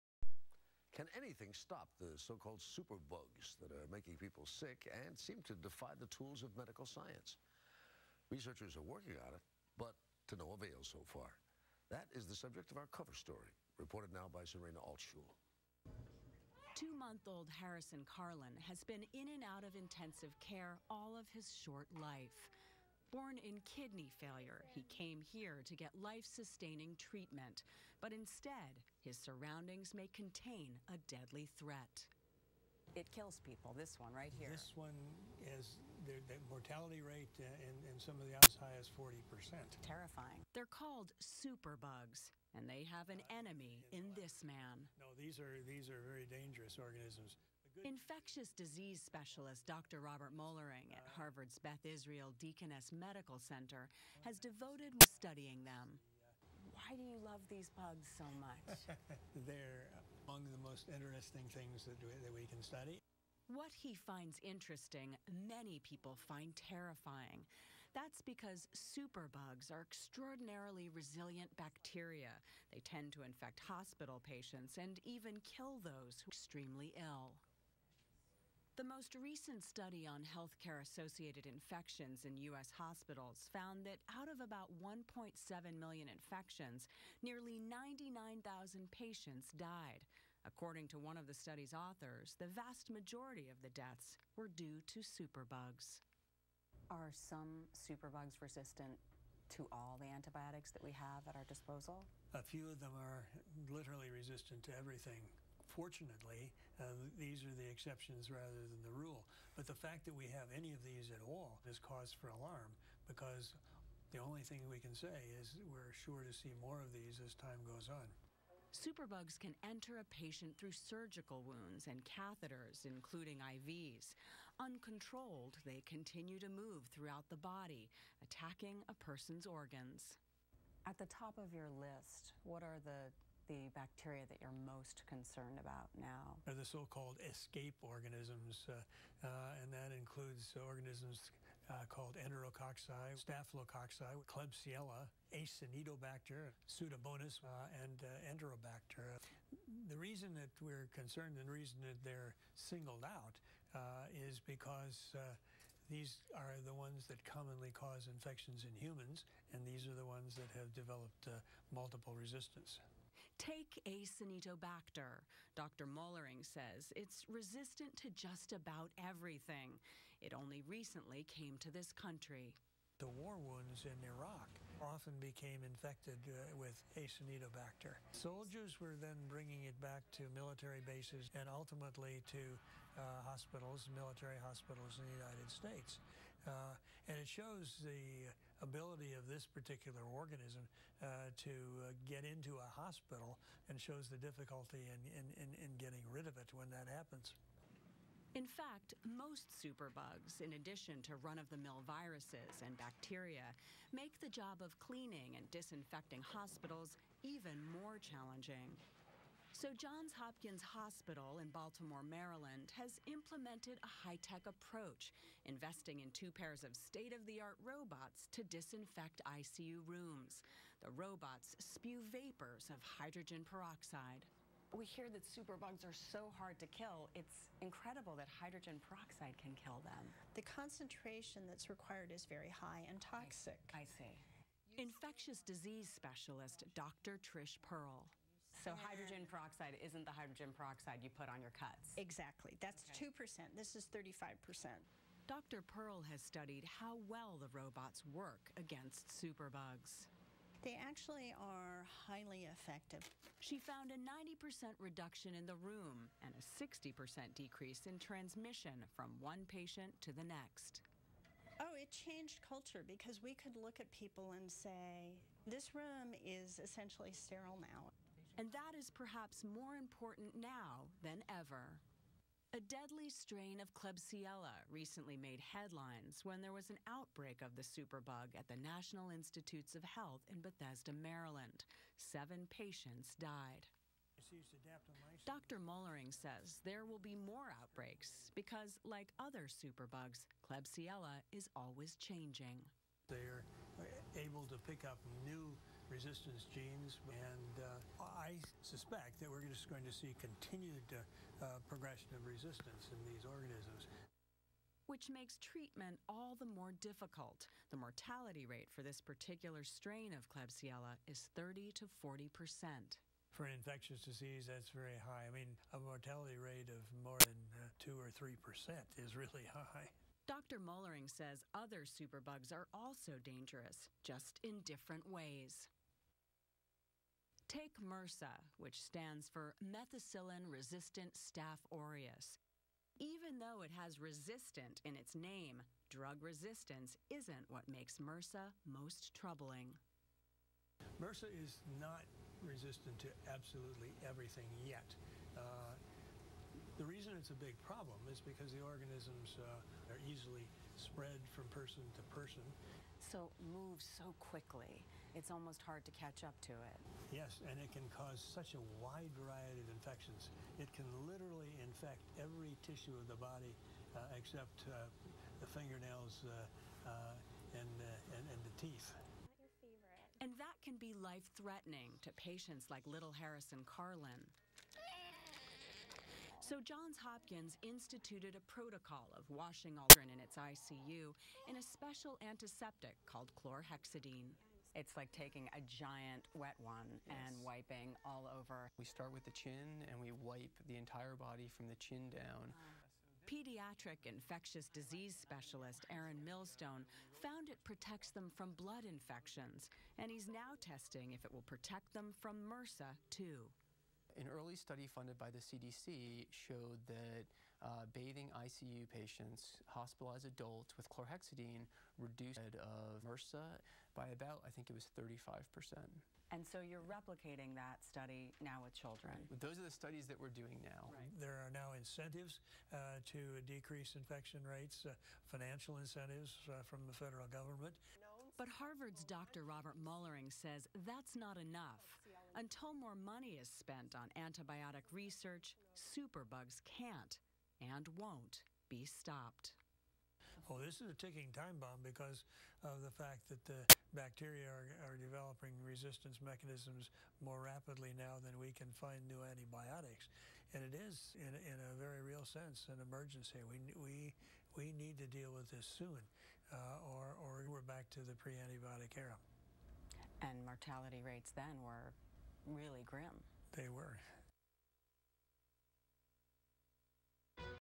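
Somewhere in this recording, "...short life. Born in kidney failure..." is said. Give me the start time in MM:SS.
00:21.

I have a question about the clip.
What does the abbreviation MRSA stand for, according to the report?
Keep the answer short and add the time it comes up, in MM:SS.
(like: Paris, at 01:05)
methicillin resistant staph aureus, at 05:29.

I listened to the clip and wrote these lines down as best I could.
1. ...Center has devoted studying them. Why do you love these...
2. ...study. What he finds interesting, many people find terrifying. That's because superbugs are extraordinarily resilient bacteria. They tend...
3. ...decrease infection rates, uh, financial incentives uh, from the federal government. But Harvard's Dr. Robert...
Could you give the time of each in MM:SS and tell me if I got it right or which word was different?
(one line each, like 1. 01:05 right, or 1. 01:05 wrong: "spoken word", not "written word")
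1. 00:53 right
2. 01:02 right
3. 07:03 right.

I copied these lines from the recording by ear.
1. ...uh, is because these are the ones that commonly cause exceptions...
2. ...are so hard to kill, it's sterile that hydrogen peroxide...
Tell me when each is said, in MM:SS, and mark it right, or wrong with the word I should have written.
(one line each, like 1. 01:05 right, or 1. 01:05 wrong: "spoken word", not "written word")
1. 02:33 wrong: "infections", not "exceptions"
2. 03:45 wrong: "incredible", not "sterile".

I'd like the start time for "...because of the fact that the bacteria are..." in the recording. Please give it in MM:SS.
07:21.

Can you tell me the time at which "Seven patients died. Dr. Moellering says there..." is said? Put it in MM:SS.
04:42.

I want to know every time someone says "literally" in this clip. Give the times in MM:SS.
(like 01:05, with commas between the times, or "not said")
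01:43, 06:01.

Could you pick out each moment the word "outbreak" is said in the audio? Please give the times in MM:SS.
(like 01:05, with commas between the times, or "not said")
04:36, 04:47.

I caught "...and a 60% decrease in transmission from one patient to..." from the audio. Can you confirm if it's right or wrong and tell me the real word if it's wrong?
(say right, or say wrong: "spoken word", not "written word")
right.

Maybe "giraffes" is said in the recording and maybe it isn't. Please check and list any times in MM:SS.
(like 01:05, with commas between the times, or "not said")
not said.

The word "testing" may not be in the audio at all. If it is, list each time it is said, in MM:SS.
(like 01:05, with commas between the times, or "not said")
06:40.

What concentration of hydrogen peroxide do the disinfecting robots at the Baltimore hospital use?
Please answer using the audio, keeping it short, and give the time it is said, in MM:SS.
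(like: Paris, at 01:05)
35%, at 04:03.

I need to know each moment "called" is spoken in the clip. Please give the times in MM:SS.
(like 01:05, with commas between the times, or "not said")
00:02, 00:40, 02:16, 02:21, 06:23.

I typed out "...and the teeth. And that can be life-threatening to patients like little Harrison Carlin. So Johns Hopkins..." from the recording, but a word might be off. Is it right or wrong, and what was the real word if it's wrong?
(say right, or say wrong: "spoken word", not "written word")
right.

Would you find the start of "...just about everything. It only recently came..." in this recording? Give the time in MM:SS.
02:48.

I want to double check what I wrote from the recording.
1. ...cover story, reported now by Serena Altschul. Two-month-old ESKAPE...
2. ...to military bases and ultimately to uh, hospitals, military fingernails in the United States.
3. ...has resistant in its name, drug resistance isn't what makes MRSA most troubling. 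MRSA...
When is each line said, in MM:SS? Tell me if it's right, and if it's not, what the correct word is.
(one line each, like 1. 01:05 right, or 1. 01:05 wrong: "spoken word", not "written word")
1. 00:12 wrong: "Harrison", not "ESKAPE"
2. 03:00 wrong: "hospitals", not "fingernails"
3. 05:33 right.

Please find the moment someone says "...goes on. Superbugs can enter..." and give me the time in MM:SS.
01:57.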